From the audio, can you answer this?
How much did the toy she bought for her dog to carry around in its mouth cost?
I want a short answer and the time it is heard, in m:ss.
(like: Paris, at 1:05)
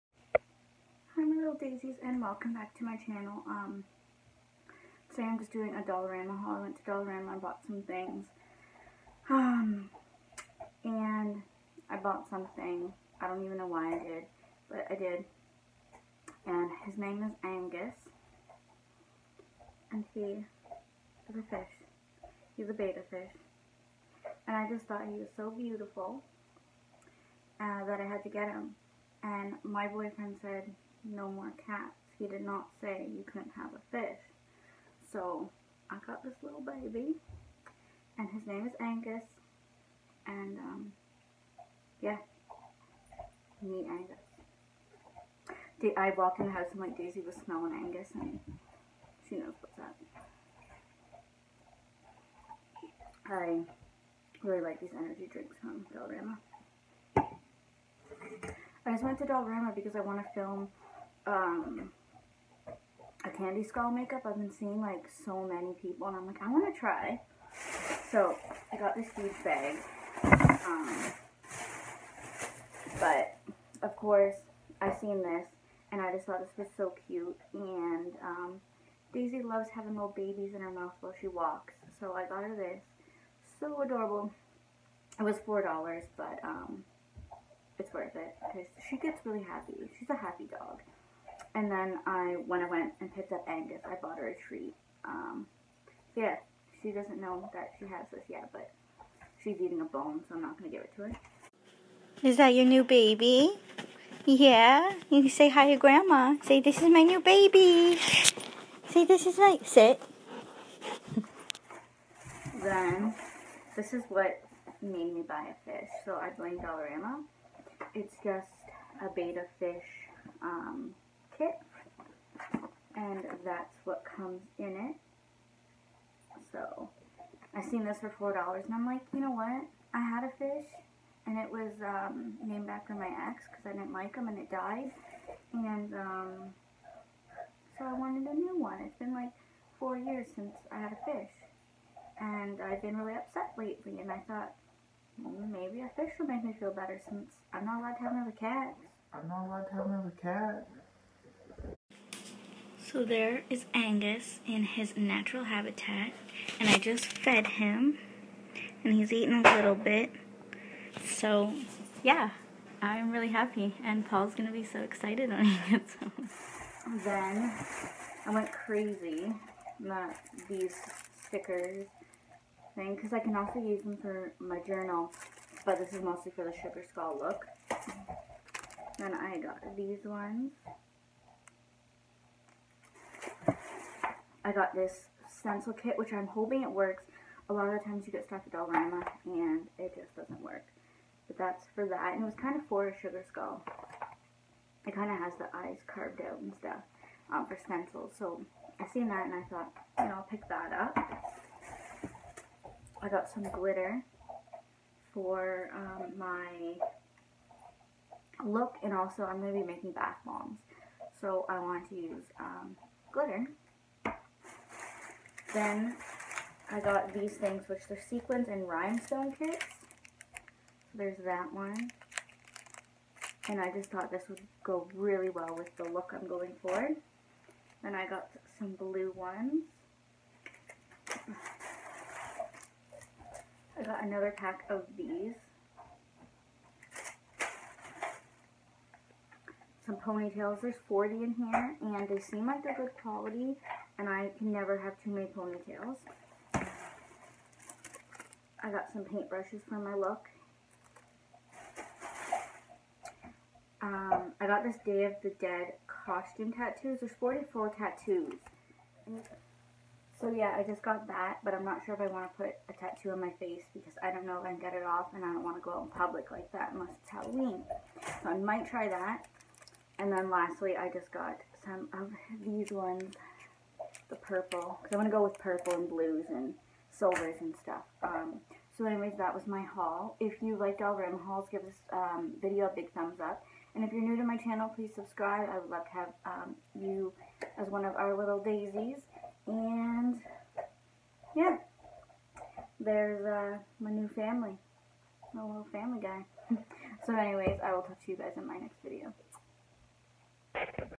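$4, at 1:25.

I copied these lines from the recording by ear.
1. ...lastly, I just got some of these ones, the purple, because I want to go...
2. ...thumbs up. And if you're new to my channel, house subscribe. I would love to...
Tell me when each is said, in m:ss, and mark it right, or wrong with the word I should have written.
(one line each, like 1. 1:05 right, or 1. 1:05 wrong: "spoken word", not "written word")
1. 4:30 right
2. 4:42 wrong: "please", not "house".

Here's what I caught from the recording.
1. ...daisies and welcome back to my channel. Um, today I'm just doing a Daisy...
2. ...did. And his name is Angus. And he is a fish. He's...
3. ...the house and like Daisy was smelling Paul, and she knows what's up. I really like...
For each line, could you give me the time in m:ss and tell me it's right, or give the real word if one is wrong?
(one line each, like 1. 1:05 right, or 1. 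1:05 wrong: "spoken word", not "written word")
1. 0:01 wrong: "Dollarama", not "Daisy"
2. 0:14 right
3. 0:46 wrong: "Angus", not "Paul".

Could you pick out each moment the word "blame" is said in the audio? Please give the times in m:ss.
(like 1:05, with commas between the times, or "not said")
1:56.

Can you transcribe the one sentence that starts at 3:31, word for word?
So I want to use um, glitter then I got these things, which are sequins and rhinestone kits.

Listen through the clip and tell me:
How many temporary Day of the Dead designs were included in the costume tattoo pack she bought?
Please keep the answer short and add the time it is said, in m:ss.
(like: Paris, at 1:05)
44, at 4:16.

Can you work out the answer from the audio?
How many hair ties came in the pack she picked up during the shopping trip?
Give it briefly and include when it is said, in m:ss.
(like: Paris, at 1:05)
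40, at 4:00.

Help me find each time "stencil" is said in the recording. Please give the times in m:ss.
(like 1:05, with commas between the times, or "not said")
3:05, 3:17.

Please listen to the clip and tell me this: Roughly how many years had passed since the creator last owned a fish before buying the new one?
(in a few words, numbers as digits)
4 years.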